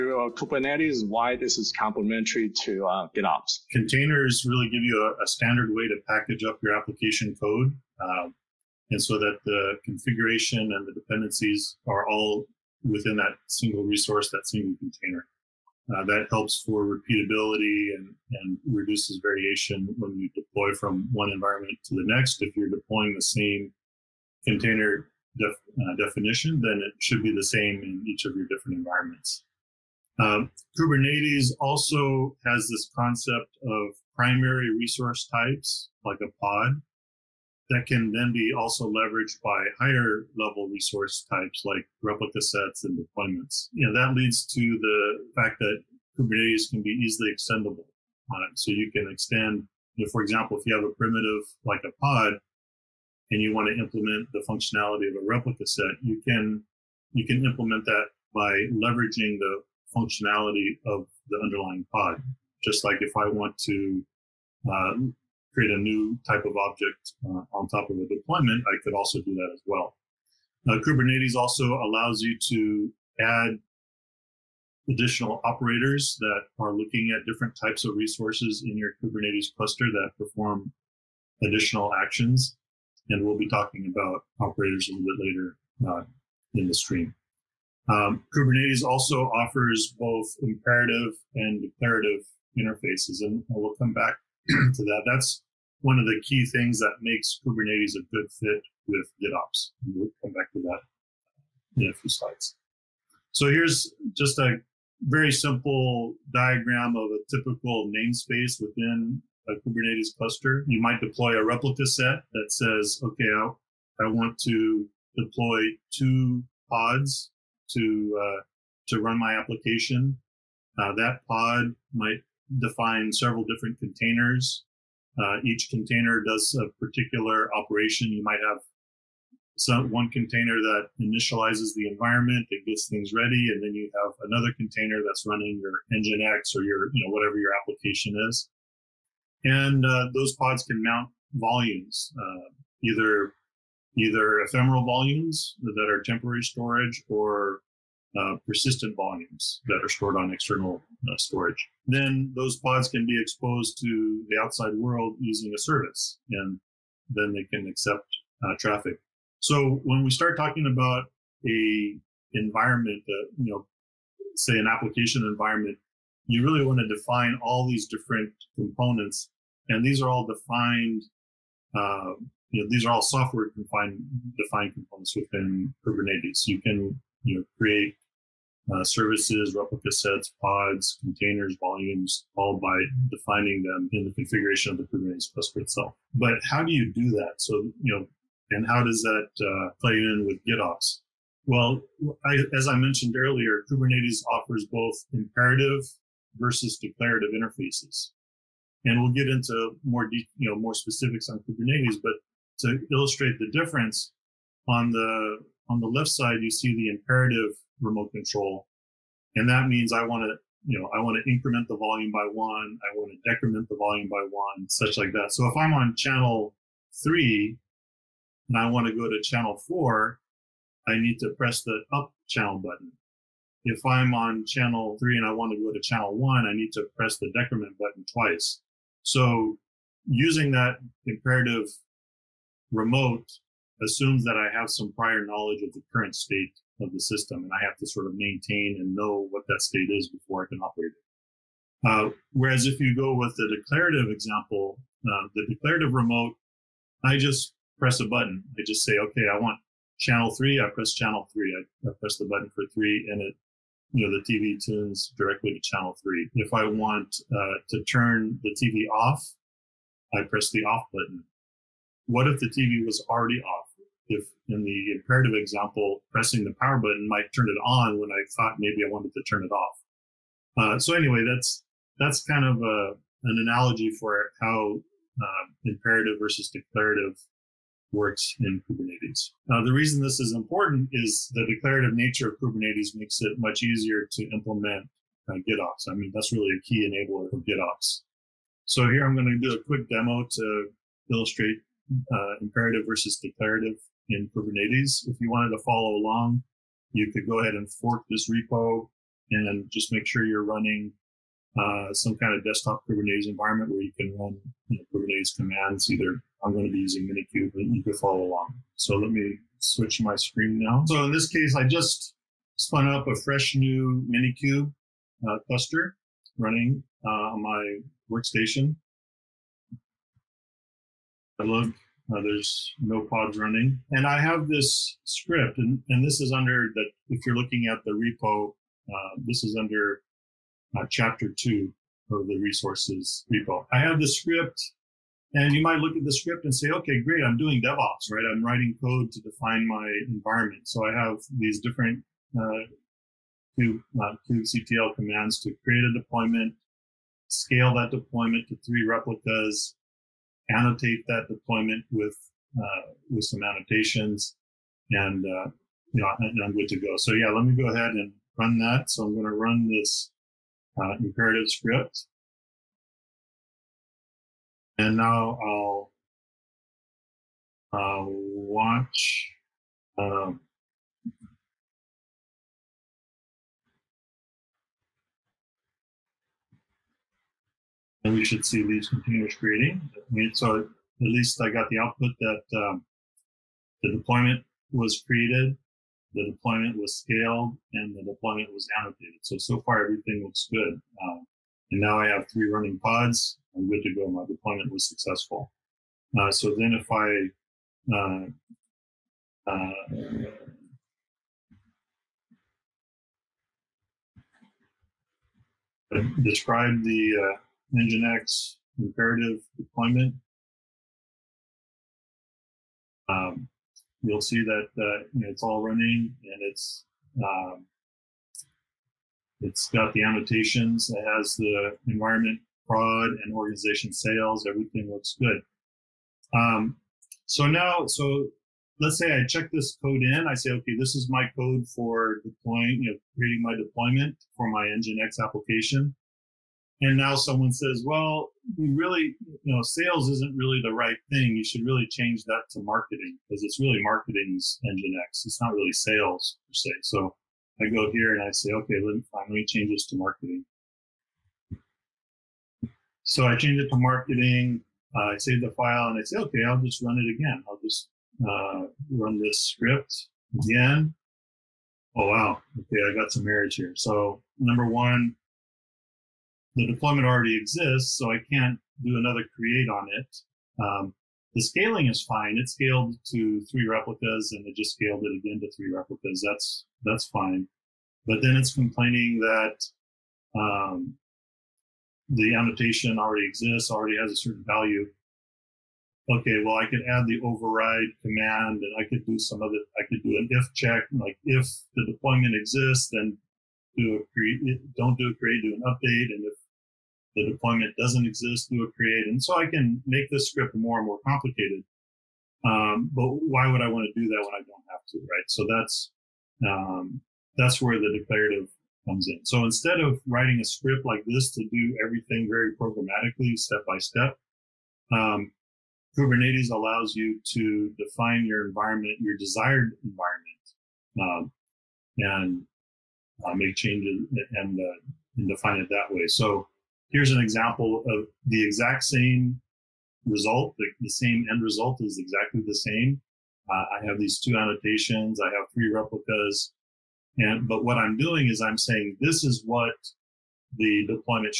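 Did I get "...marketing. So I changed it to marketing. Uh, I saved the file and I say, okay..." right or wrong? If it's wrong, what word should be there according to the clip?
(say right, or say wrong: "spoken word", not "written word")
right.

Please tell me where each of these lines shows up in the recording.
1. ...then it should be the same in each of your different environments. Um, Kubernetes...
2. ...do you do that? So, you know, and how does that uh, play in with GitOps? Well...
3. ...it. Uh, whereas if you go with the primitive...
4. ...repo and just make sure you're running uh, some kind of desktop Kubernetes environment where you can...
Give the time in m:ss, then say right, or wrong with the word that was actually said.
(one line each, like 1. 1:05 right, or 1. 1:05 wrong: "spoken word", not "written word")
1. 0:26 right
2. 3:06 right
3. 4:00 wrong: "declarative", not "primitive"
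4. 4:58 right.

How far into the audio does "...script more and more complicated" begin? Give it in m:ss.
8:20.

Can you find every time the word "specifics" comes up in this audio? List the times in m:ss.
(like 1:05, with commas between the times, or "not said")
3:20.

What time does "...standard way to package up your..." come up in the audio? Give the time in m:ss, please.
0:05.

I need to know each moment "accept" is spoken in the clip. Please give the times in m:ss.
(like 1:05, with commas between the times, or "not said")
2:37.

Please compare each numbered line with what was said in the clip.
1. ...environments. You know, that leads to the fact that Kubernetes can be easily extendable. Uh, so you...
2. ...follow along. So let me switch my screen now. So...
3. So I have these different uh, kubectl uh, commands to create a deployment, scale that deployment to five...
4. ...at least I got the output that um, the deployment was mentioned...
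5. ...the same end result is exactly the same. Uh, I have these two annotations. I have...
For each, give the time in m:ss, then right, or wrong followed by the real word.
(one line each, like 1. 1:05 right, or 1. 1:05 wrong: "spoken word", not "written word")
1. 0:42 wrong: "deployments", not "environments"
2. 5:07 right
3. 5:40 wrong: "three", not "five"
4. 6:20 wrong: "created", not "mentioned"
5. 8:50 right.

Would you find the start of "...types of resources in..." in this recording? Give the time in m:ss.
1:17.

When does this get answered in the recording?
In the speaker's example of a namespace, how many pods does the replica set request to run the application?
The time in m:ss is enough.
1:55.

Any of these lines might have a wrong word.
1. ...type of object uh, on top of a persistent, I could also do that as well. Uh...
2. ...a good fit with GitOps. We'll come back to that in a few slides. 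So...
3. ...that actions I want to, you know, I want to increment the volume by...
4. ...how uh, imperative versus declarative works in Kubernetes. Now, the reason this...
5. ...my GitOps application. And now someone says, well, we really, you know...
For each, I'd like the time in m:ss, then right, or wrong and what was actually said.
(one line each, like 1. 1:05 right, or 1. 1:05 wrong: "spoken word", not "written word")
1. 1:06 wrong: "deployment", not "persistent"
2. 1:37 right
3. 3:29 wrong: "means", not "actions"
4. 4:34 right
5. 7:14 wrong: "Nginx", not "GitOps".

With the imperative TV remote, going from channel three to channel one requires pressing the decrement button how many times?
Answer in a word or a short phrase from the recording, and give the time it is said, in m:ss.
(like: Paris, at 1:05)
twice, at 3:48.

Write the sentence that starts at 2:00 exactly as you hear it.
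Uh, that pod might define several different containers.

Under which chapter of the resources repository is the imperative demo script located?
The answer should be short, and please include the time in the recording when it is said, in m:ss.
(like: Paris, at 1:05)
chapter two, at 5:30.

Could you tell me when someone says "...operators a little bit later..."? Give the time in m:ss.
1:24.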